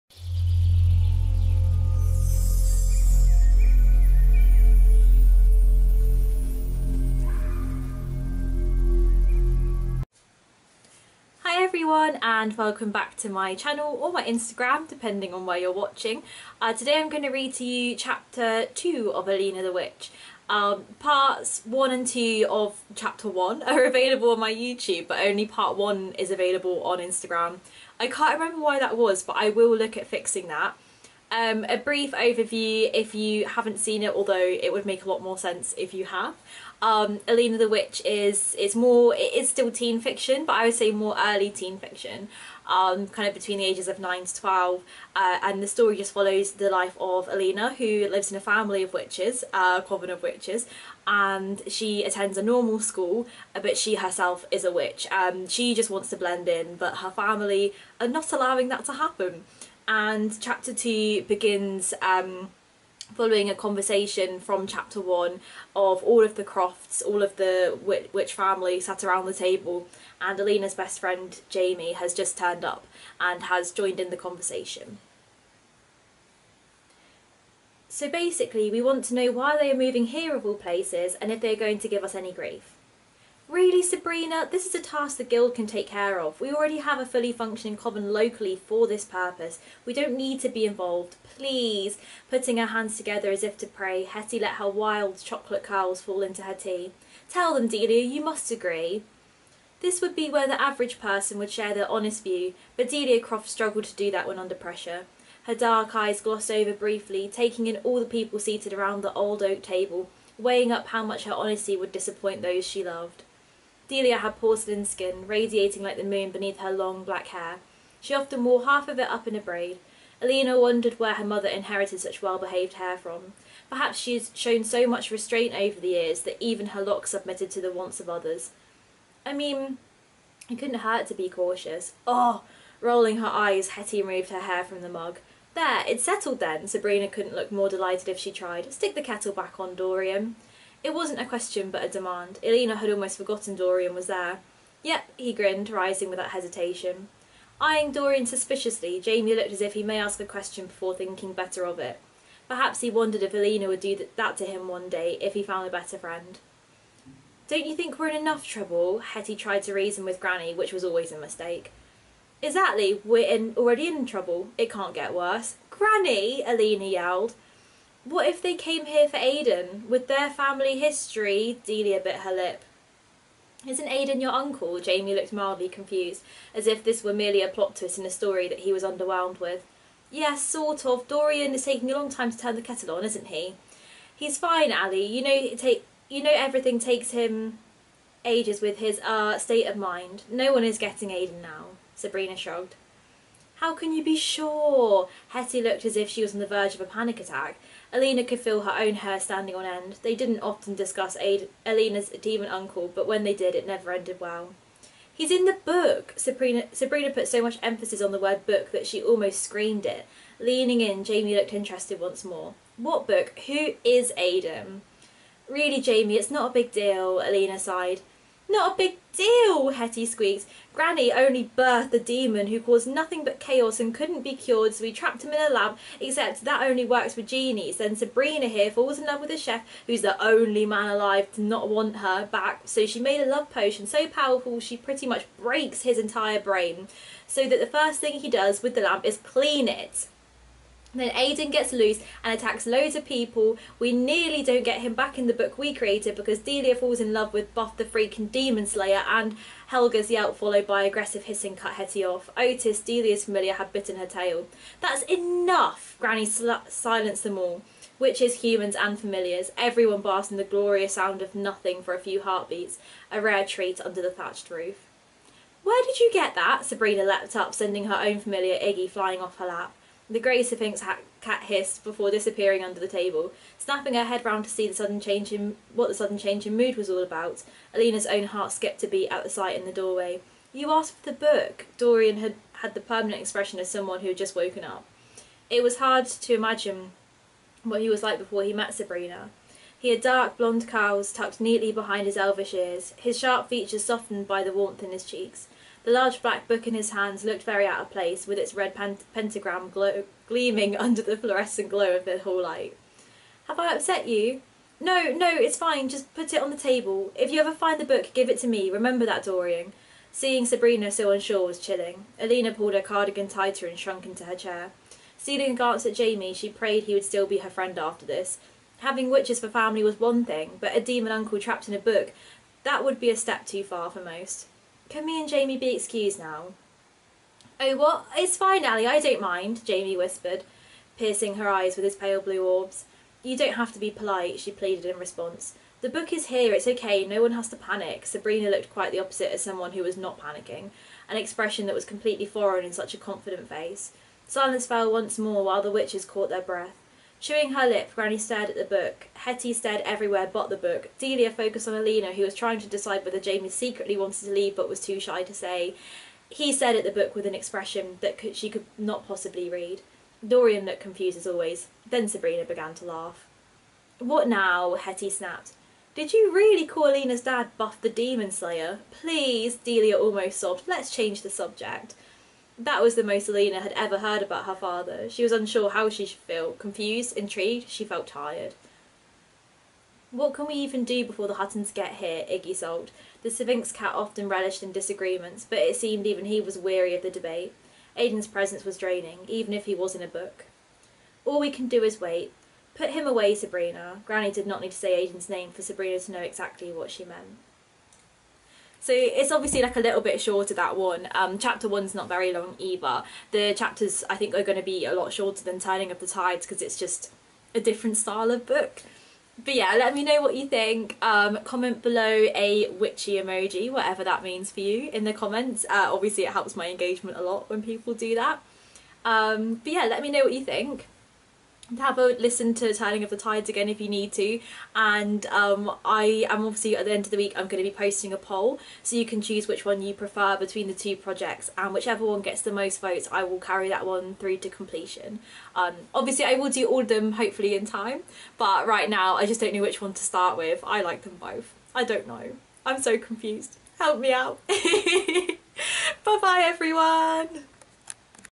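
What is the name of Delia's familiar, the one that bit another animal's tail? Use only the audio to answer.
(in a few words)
Otis.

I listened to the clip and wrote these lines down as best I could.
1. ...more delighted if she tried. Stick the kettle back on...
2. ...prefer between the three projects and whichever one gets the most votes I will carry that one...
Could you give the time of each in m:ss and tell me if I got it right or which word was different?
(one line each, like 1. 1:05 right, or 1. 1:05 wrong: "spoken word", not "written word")
1. 2:17 right
2. 7:09 wrong: "two", not "three".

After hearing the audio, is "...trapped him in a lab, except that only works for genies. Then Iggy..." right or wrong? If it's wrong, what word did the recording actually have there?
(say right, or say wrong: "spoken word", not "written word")
wrong: "Sabrina", not "Iggy".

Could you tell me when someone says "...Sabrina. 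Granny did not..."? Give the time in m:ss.
6:33.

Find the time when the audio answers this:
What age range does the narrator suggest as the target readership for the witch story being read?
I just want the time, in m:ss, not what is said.
0:43.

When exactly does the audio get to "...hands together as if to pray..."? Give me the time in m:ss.
1:32.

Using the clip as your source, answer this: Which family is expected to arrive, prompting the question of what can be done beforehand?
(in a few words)
The Huttons.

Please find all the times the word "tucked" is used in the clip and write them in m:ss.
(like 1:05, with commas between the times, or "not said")
4:51.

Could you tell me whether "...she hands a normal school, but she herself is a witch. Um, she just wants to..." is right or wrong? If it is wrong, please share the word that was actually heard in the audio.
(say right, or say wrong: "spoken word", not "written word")
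wrong: "attends", not "hands".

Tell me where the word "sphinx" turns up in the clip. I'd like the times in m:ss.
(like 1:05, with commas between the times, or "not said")
4:30, 6:23.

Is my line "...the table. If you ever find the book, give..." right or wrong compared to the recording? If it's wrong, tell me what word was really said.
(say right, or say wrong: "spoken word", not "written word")
right.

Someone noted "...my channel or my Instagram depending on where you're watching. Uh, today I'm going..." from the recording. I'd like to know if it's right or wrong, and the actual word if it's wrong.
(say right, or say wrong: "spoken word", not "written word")
right.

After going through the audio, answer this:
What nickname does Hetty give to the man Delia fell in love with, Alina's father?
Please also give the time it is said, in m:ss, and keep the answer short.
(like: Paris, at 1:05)
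Buff the Demon Slayer, at 4:07.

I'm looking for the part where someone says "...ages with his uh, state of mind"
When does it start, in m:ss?
3:08.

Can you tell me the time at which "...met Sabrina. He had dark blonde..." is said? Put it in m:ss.
4:48.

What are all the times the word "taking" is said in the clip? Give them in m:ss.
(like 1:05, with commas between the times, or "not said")
1:47, 3:01.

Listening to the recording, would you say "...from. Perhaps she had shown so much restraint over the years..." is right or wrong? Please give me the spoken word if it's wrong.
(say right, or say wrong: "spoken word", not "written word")
right.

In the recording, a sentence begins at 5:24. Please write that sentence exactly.
Can me and Jamie be excused now?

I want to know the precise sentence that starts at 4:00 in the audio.
Then Aiden gets loose and attacks loads of people.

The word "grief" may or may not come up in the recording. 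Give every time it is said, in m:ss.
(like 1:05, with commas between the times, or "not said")
1:22.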